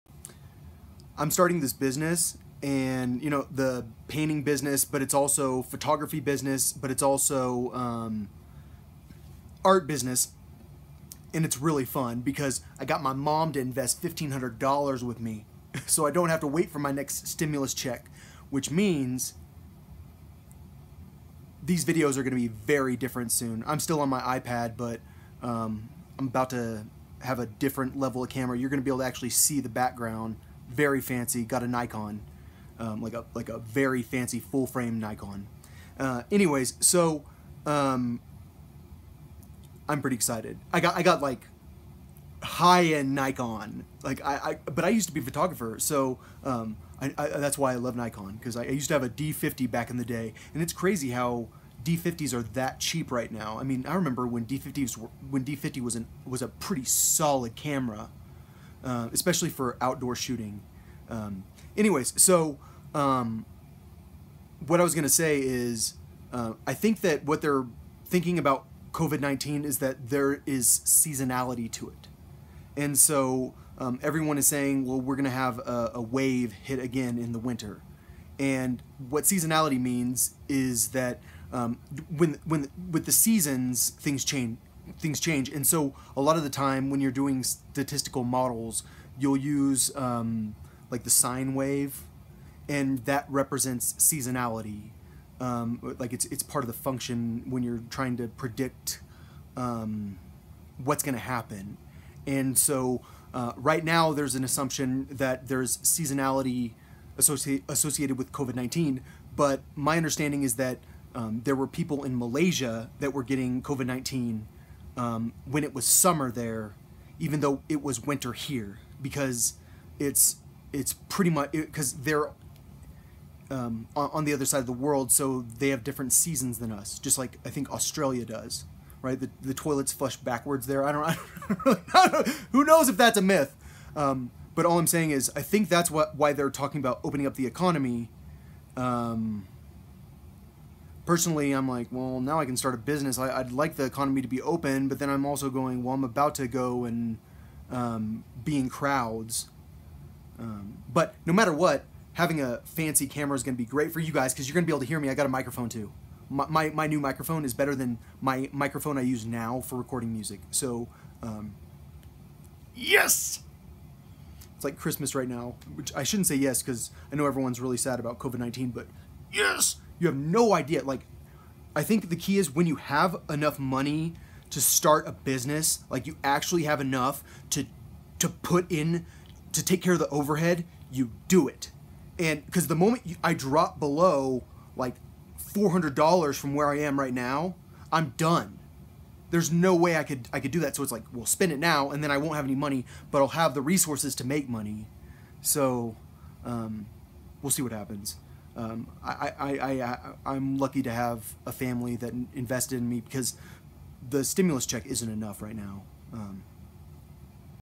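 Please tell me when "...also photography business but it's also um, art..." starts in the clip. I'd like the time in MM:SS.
00:05.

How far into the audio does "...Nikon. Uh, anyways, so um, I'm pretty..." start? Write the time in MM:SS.
00:34.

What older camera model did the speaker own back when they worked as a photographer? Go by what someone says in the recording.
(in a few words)
D50.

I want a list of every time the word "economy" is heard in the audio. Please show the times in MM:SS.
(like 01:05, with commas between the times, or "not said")
02:17, 02:23.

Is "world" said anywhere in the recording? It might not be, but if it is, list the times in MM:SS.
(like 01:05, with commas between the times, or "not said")
02:04.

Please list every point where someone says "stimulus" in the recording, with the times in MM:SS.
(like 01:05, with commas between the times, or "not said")
00:17, 03:24.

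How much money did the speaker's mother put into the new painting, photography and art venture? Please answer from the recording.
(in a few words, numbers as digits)
$1,500.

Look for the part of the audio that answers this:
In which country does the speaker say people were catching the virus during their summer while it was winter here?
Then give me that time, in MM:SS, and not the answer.
01:52.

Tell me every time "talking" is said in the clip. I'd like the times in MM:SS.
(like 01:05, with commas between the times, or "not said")
02:16.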